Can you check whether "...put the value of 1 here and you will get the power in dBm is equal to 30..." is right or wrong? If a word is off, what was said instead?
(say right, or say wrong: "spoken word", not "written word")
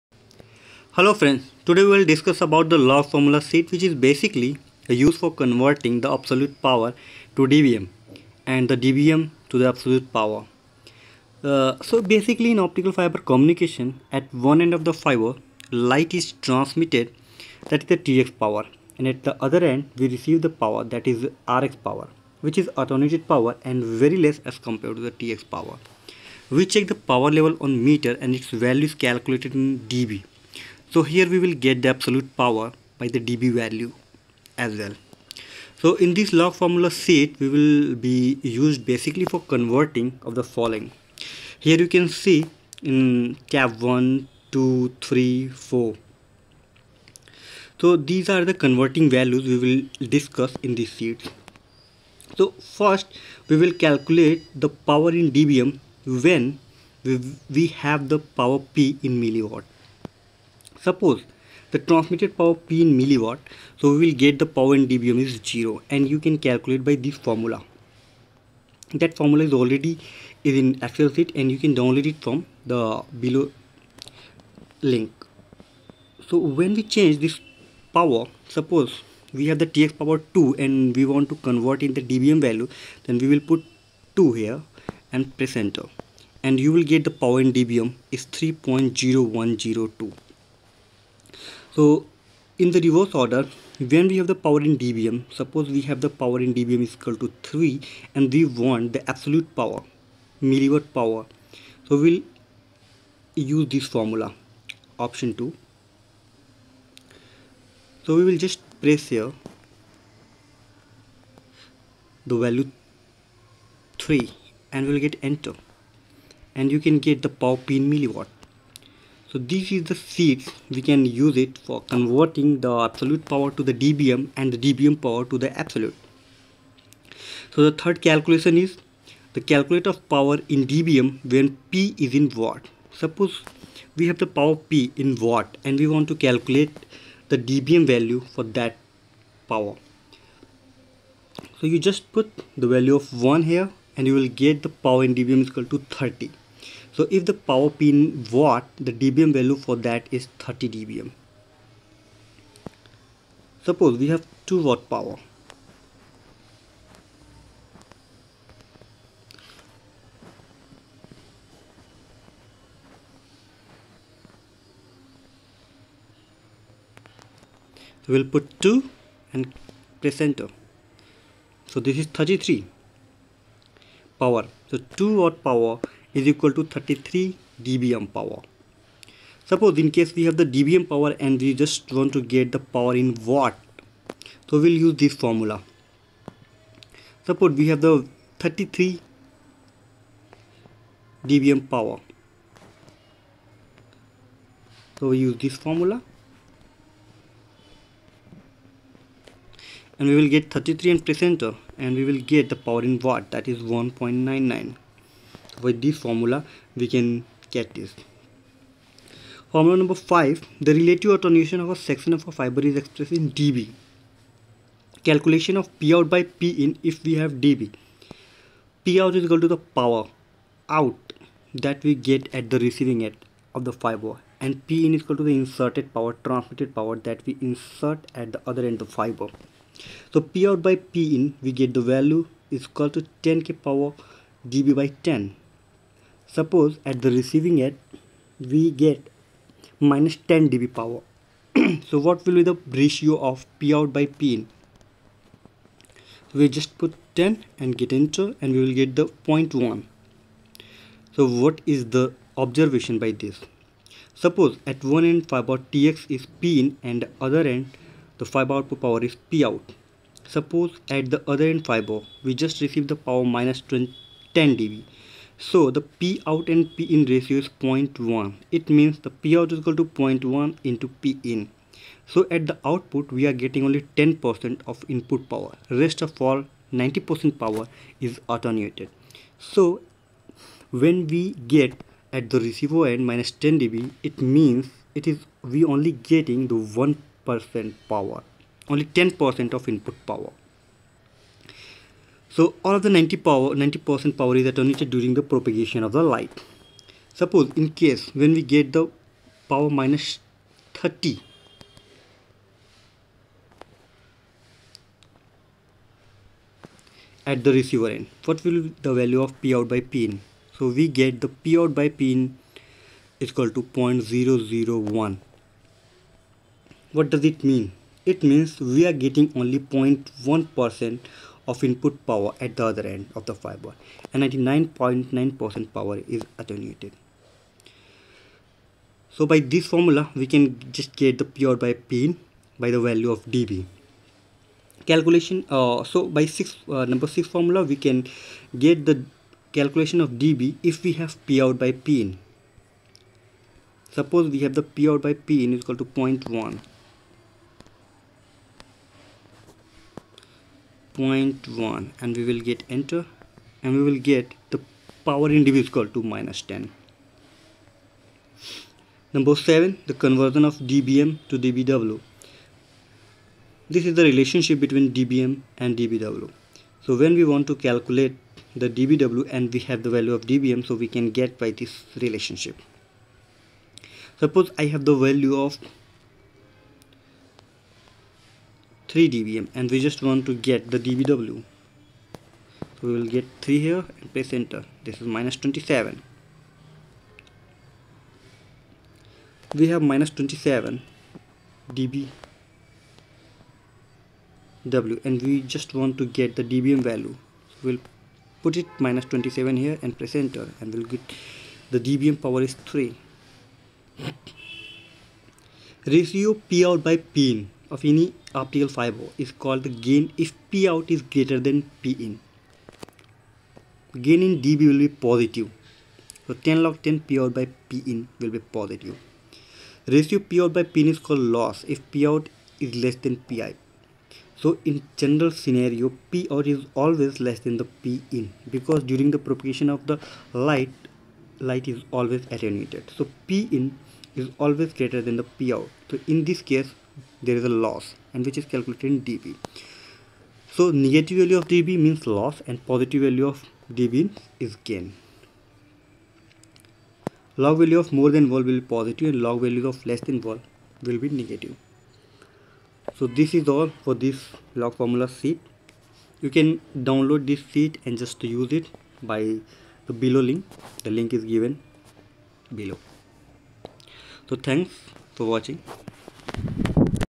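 right.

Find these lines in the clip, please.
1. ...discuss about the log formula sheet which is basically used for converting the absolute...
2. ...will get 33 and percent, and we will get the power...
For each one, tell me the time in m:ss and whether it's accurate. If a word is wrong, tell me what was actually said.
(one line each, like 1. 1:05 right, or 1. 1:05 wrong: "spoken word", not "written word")
1. 0:02 right
2. 3:20 right.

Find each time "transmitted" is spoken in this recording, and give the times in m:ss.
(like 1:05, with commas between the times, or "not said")
0:16, 1:01, 3:46.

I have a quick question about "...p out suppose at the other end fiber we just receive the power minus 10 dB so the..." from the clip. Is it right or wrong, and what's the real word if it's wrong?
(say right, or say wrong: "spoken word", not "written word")
right.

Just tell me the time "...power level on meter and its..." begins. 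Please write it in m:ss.
0:26.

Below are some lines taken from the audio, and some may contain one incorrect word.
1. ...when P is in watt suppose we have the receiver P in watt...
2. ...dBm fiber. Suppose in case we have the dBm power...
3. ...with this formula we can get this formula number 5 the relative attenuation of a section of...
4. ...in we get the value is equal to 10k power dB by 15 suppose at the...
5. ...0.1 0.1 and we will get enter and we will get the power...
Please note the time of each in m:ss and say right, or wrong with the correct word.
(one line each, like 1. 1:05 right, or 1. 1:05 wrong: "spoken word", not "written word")
1. 2:11 wrong: "power", not "receiver"
2. 2:57 wrong: "power", not "fiber"
3. 3:25 right
4. 3:51 wrong: "10", not "15"
5. 5:45 right.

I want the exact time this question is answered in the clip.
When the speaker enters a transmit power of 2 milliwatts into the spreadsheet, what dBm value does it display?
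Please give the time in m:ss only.
1:28.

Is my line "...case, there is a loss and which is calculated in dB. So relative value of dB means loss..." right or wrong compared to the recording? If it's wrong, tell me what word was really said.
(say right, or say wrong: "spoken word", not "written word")
wrong: "negative", not "relative".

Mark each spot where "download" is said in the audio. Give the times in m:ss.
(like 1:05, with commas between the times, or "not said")
1:11, 7:36.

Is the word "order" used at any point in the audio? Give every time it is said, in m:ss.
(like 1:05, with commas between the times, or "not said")
1:33.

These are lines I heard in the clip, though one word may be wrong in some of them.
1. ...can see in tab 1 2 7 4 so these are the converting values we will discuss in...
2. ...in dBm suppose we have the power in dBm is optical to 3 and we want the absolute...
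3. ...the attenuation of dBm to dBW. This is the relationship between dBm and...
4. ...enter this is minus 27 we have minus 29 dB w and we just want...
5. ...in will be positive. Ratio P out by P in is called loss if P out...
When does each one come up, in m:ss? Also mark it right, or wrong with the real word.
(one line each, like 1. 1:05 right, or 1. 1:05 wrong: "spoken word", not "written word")
1. 0:41 wrong: "3", not "7"
2. 1:34 wrong: "equal", not "optical"
3. 5:59 wrong: "conversion", not "attenuation"
4. 6:24 wrong: "27", not "29"
5. 6:57 right.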